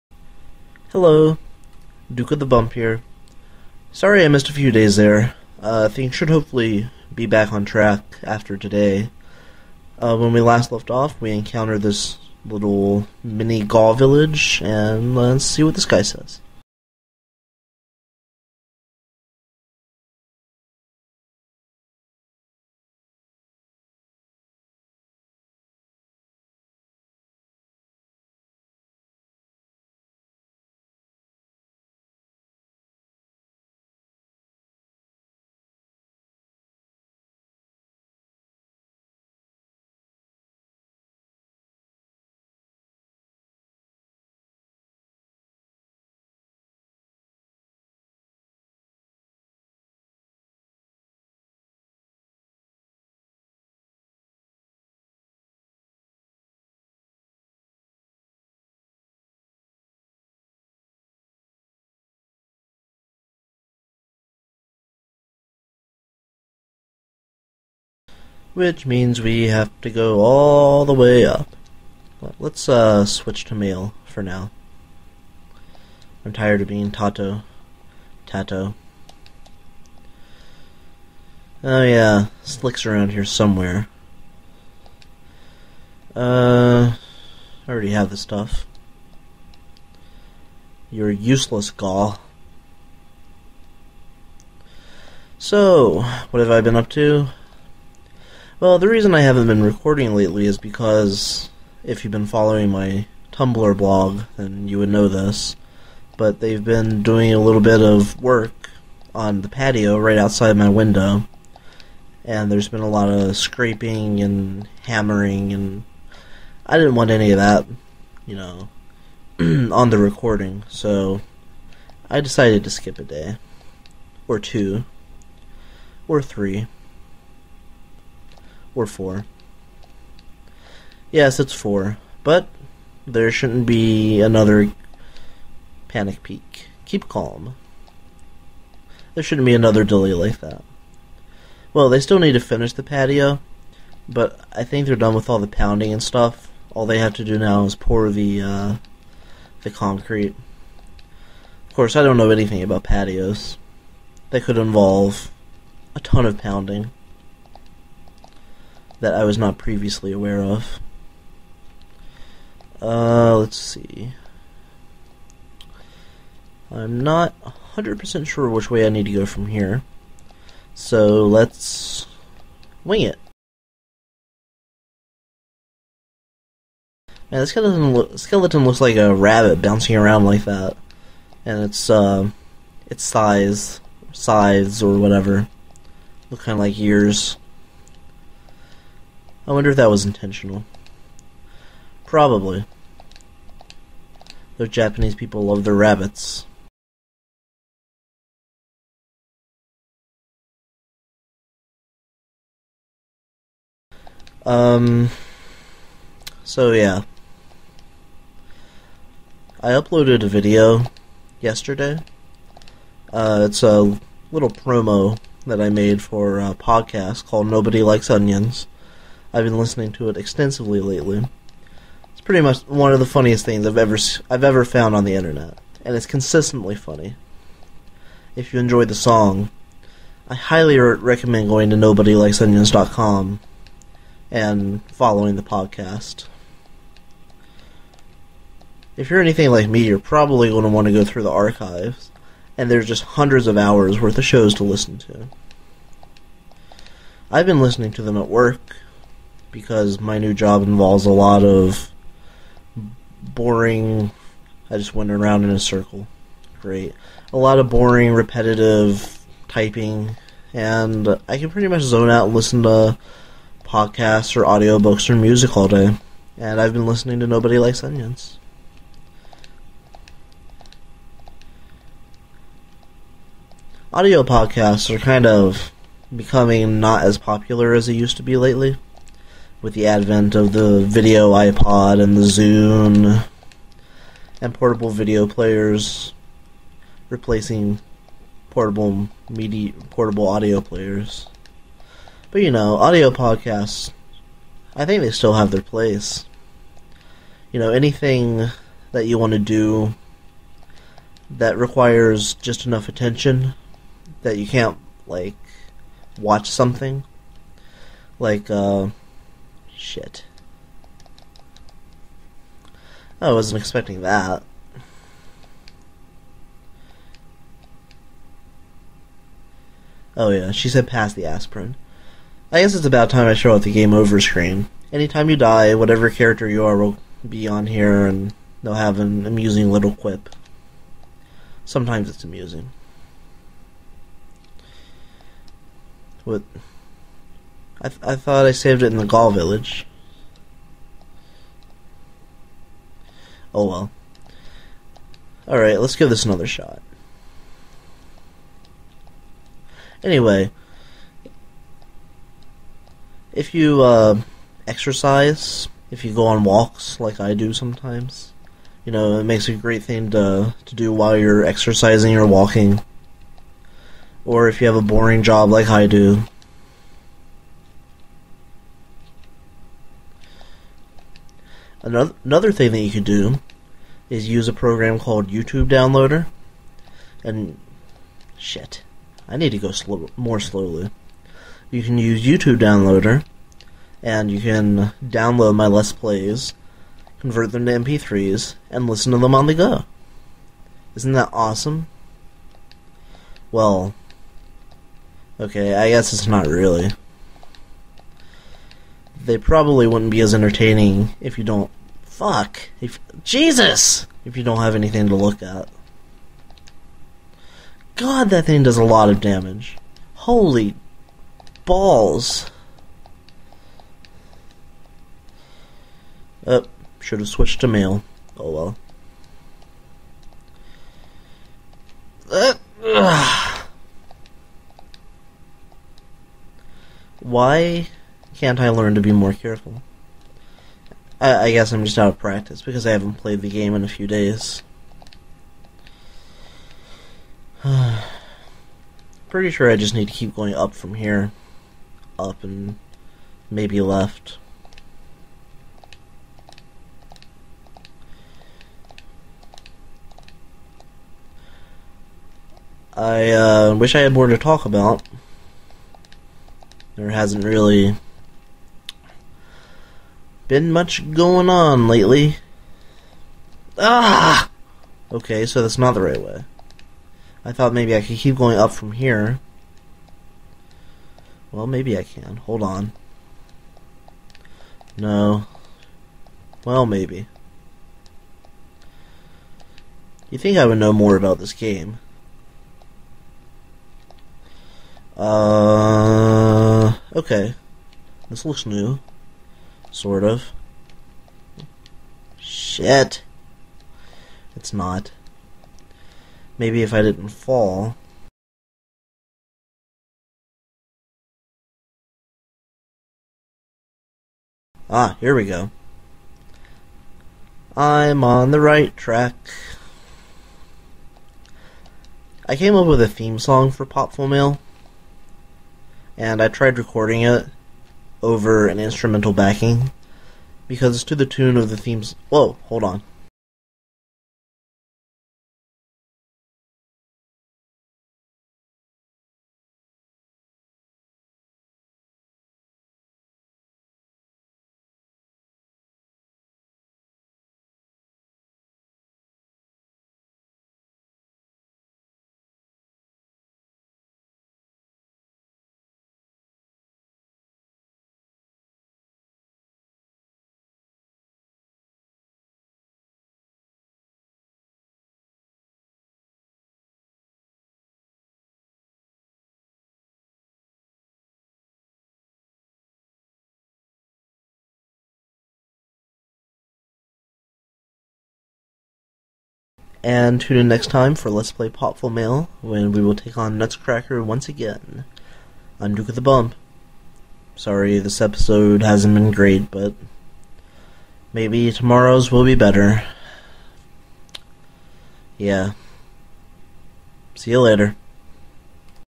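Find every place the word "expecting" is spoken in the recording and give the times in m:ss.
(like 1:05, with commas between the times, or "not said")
5:13.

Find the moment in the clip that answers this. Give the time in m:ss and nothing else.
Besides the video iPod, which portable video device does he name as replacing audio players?
4:42.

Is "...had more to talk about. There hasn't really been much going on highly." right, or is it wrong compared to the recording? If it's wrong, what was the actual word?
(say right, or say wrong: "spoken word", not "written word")
wrong: "lately", not "highly".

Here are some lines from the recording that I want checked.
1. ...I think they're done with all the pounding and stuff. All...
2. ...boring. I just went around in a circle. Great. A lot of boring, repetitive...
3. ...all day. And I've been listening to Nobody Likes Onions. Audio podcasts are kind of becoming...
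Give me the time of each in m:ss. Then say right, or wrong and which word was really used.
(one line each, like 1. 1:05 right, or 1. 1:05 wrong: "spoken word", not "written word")
1. 2:24 right
2. 4:13 right
3. 4:25 right.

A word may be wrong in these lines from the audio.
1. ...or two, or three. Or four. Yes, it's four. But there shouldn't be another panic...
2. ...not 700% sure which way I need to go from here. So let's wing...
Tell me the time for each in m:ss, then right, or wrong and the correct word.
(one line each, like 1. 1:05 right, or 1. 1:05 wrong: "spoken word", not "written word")
1. 2:04 right
2. 2:47 wrong: "100", not "700".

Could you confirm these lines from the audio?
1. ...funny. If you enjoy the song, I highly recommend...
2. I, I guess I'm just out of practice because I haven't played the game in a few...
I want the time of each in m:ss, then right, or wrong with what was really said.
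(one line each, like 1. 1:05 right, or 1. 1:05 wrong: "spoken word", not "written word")
1. 3:46 right
2. 7:11 right.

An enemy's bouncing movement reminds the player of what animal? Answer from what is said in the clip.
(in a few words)
rabbit.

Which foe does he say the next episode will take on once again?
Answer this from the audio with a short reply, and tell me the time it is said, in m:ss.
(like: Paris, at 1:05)
Nutcracker, at 9:33.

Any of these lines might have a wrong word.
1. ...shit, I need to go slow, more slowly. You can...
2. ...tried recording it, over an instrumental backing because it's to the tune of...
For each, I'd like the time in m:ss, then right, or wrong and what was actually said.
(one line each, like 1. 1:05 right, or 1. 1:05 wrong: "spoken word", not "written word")
1. 6:18 right
2. 8:36 right.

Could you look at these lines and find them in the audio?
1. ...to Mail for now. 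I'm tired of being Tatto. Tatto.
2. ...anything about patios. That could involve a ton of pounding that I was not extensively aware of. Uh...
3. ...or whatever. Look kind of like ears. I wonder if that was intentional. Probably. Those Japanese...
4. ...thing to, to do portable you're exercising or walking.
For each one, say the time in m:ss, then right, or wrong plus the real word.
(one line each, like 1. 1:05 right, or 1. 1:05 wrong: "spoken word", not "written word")
1. 1:13 right
2. 2:32 wrong: "previously", not "extensively"
3. 3:04 right
4. 5:59 wrong: "while", not "portable".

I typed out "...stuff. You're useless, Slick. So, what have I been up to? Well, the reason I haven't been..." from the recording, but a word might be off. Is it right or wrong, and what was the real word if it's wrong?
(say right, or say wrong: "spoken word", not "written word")
wrong: "Gaw", not "Slick".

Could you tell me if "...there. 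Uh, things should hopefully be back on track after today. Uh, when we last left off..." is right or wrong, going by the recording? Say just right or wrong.
right.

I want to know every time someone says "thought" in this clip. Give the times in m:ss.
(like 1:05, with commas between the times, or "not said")
5:38, 7:47.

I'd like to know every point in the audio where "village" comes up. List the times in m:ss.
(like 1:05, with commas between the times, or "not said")
0:13, 5:39.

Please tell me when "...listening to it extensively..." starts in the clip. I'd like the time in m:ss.
3:39.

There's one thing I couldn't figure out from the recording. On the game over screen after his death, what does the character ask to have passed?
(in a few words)
the aspirin.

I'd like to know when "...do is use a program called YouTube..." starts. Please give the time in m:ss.
6:13.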